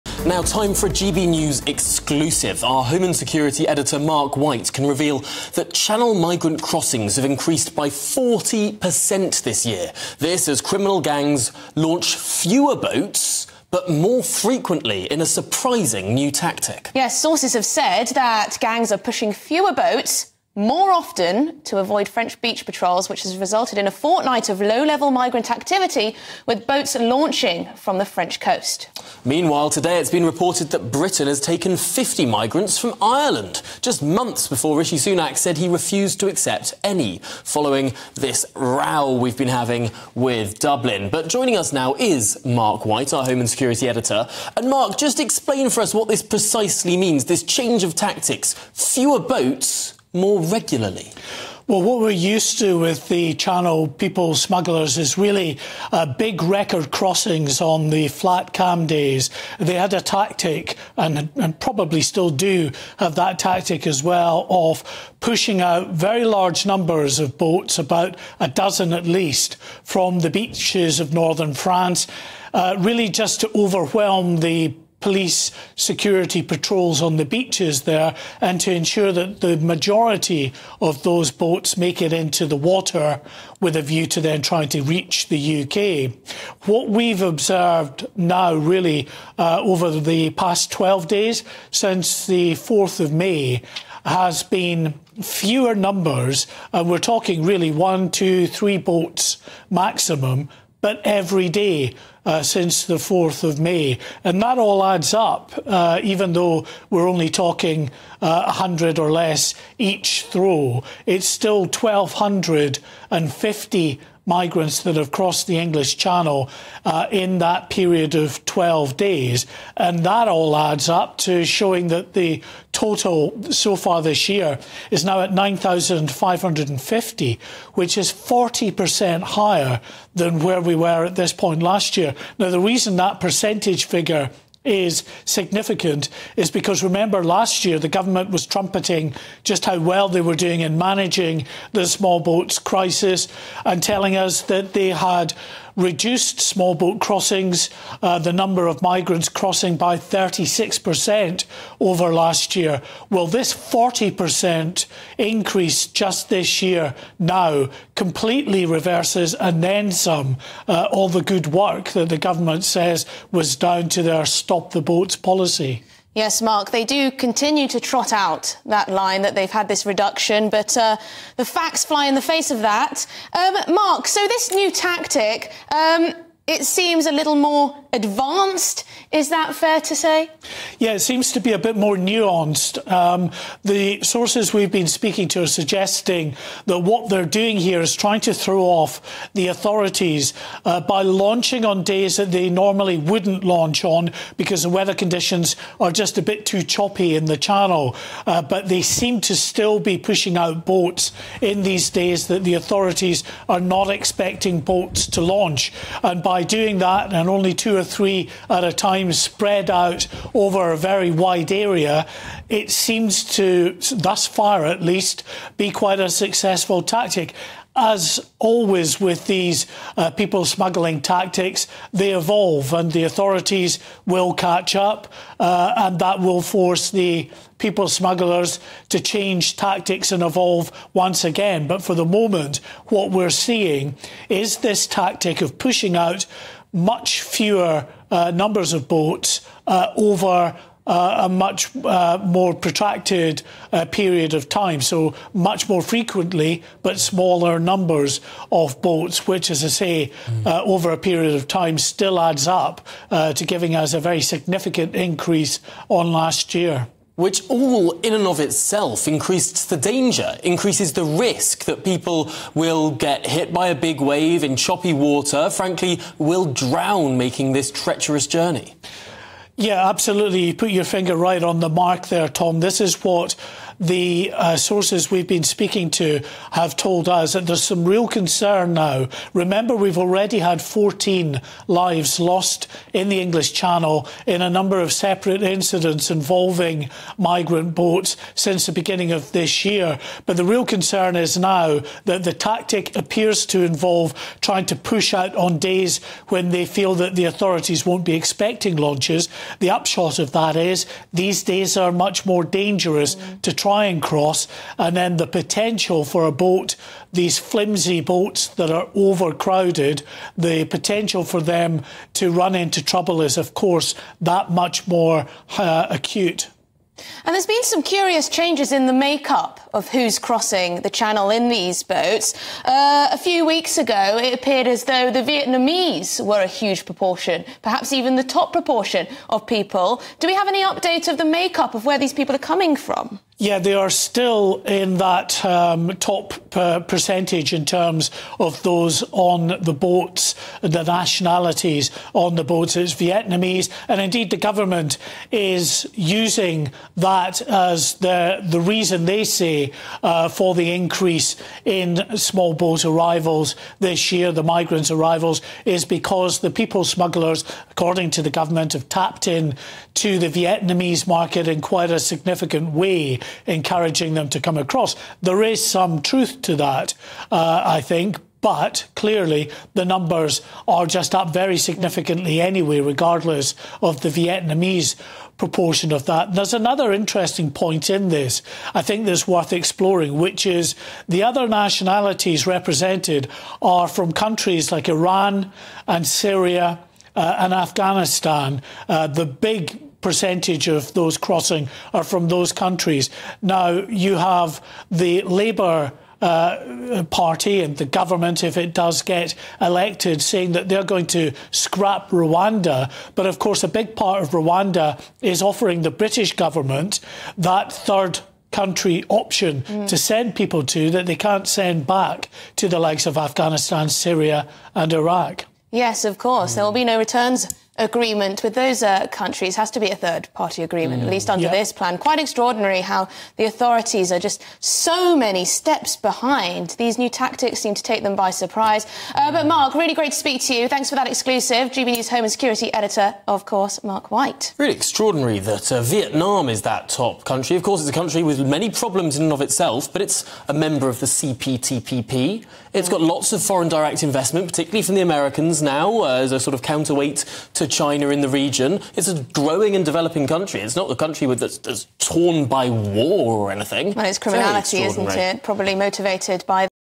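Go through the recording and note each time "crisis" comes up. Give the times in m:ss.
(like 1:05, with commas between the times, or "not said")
2:22.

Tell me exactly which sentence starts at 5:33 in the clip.
Yeah, they are still in that um, top uh, percentage in terms of those on the boats, the nationalities on the boats.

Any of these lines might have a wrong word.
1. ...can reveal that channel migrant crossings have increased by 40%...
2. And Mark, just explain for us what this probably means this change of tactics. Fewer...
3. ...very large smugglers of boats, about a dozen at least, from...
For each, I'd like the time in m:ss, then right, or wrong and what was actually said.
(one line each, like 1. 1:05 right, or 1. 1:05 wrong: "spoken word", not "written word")
1. 0:04 right
2. 0:44 wrong: "precisely", not "probably"
3. 1:05 wrong: "numbers", not "smugglers".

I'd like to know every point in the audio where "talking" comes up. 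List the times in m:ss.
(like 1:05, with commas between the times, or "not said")
1:36, 1:47.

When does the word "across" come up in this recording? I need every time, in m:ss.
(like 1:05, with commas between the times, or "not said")
6:04.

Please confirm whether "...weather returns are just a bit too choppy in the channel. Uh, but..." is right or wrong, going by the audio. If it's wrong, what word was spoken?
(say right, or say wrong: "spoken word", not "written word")
wrong: "conditions", not "returns".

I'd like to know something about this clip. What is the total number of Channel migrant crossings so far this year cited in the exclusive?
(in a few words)
9,550.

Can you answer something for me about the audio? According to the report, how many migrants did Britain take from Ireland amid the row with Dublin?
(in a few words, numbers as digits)
50.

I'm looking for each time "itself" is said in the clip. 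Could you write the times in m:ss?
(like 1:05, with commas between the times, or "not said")
4:18, 7:19.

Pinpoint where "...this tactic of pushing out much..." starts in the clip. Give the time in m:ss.
3:54.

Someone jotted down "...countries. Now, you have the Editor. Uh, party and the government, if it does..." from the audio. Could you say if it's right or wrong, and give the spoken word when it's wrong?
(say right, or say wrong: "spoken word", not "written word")
wrong: "Labour", not "Editor".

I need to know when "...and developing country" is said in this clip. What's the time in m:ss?
7:29.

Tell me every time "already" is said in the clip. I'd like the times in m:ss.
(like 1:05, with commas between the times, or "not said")
4:39.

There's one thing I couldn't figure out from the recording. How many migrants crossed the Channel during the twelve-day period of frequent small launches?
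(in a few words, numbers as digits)
1,250.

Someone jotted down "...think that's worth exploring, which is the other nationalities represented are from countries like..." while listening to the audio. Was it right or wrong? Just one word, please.
right.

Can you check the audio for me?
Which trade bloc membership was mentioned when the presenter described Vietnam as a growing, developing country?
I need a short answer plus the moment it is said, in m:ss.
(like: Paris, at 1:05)
CPTPP, at 7:21.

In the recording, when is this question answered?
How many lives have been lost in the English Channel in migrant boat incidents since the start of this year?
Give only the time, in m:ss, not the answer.
4:40.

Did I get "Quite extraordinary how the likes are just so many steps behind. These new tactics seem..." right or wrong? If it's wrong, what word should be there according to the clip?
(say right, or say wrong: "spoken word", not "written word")
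wrong: "authorities", not "likes".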